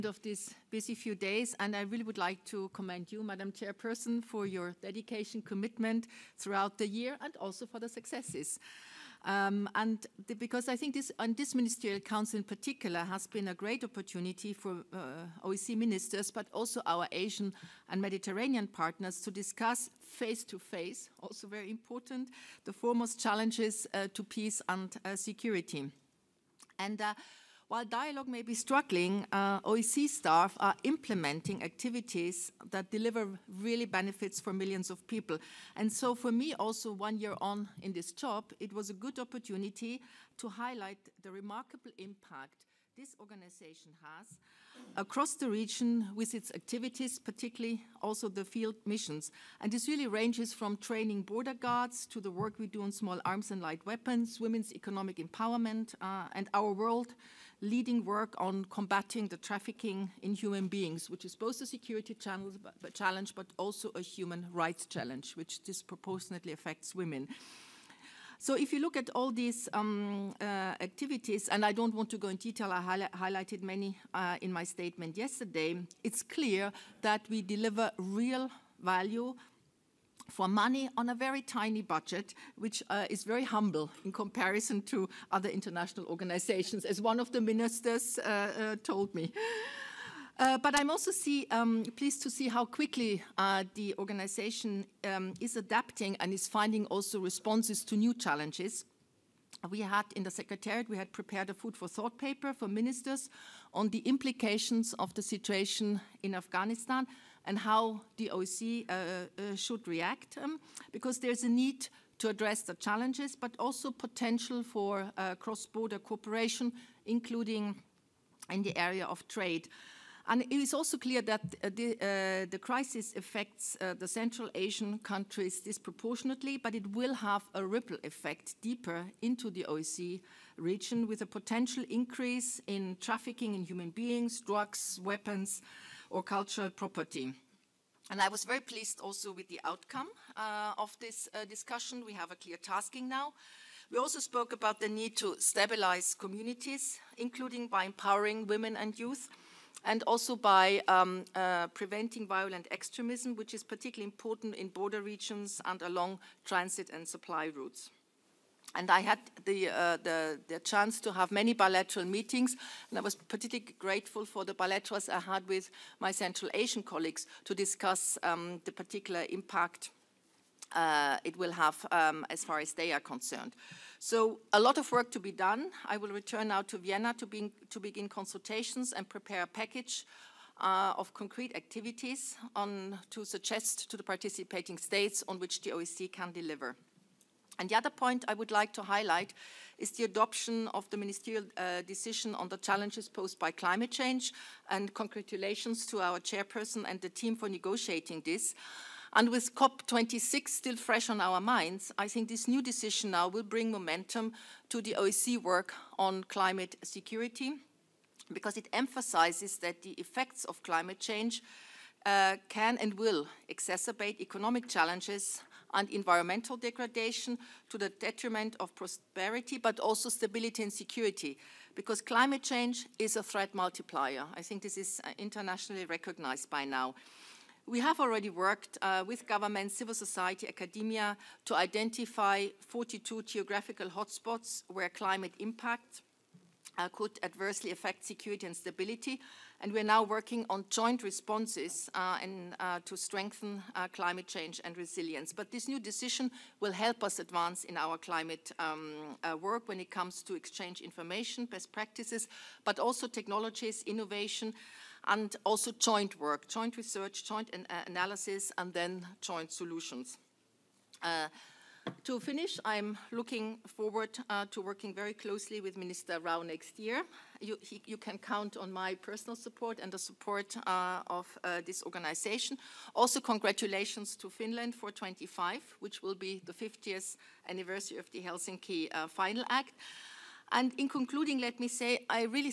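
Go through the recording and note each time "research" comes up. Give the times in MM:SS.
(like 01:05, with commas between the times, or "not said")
04:16.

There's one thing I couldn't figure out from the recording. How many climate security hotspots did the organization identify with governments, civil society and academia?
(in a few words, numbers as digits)
42.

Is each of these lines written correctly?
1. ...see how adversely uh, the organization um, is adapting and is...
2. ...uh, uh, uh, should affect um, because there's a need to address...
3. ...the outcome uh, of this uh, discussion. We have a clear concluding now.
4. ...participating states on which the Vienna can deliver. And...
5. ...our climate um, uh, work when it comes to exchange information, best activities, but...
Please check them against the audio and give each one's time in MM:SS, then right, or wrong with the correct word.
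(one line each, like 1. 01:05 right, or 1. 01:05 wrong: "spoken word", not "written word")
1. 01:32 wrong: "quickly", not "adversely"
2. 01:48 wrong: "react", not "affect"
3. 02:19 wrong: "tasking", not "concluding"
4. 03:04 wrong: "OSCE", not "Vienna"
5. 04:07 wrong: "practices", not "activities".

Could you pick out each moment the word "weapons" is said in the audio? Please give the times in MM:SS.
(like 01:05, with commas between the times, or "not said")
00:53, 02:15.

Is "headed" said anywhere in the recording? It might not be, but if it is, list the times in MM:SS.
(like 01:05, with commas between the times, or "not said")
not said.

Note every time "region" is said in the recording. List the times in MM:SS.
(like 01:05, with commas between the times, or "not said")
00:45, 02:10, 02:35.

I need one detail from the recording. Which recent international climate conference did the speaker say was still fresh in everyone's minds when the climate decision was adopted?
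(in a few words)
COP26.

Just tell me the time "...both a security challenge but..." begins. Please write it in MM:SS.
01:01.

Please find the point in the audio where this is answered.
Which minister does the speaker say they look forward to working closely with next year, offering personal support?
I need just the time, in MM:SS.
04:25.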